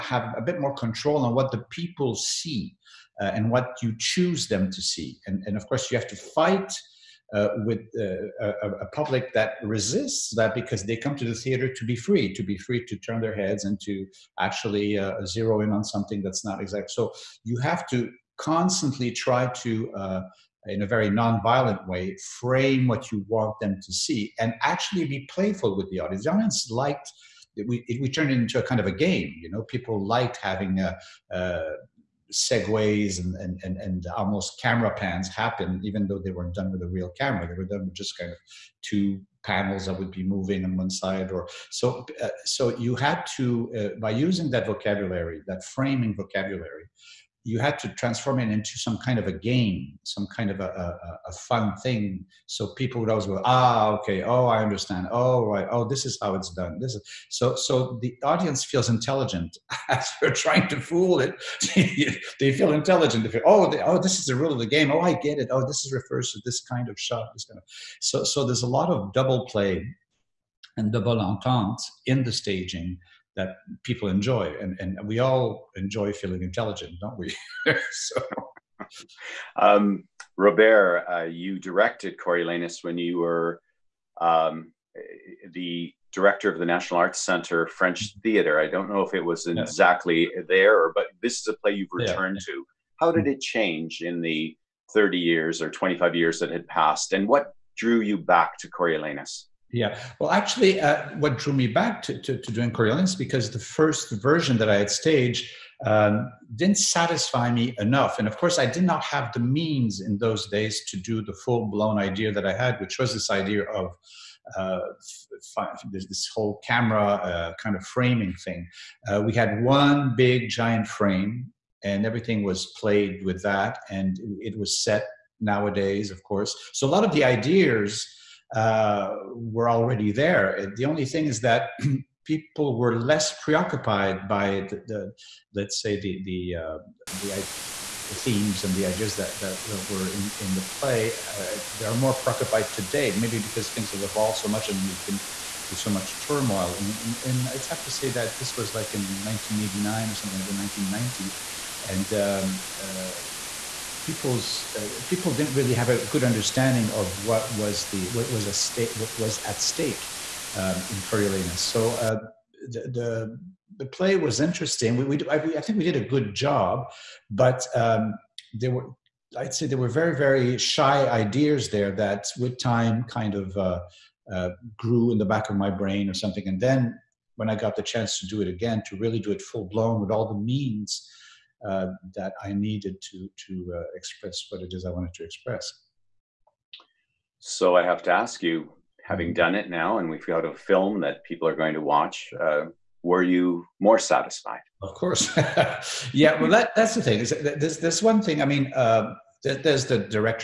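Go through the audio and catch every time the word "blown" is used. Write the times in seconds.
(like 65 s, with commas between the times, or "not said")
111 s, 179 s.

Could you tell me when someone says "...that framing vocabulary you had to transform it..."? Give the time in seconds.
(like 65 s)
45 s.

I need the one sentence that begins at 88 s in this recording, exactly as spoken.
theater i don't know if it was yeah.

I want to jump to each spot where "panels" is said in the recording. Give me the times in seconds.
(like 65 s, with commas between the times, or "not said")
39 s.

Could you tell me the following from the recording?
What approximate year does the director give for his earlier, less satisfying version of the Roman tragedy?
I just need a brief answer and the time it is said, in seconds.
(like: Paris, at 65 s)
1989, at 149 s.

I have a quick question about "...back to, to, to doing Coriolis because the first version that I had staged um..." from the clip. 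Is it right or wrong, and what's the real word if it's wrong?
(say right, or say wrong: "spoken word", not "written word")
right.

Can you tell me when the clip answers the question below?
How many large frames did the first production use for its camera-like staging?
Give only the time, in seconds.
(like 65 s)
119 s.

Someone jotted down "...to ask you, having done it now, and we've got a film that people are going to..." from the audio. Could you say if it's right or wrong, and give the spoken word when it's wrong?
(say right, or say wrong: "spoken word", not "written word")
right.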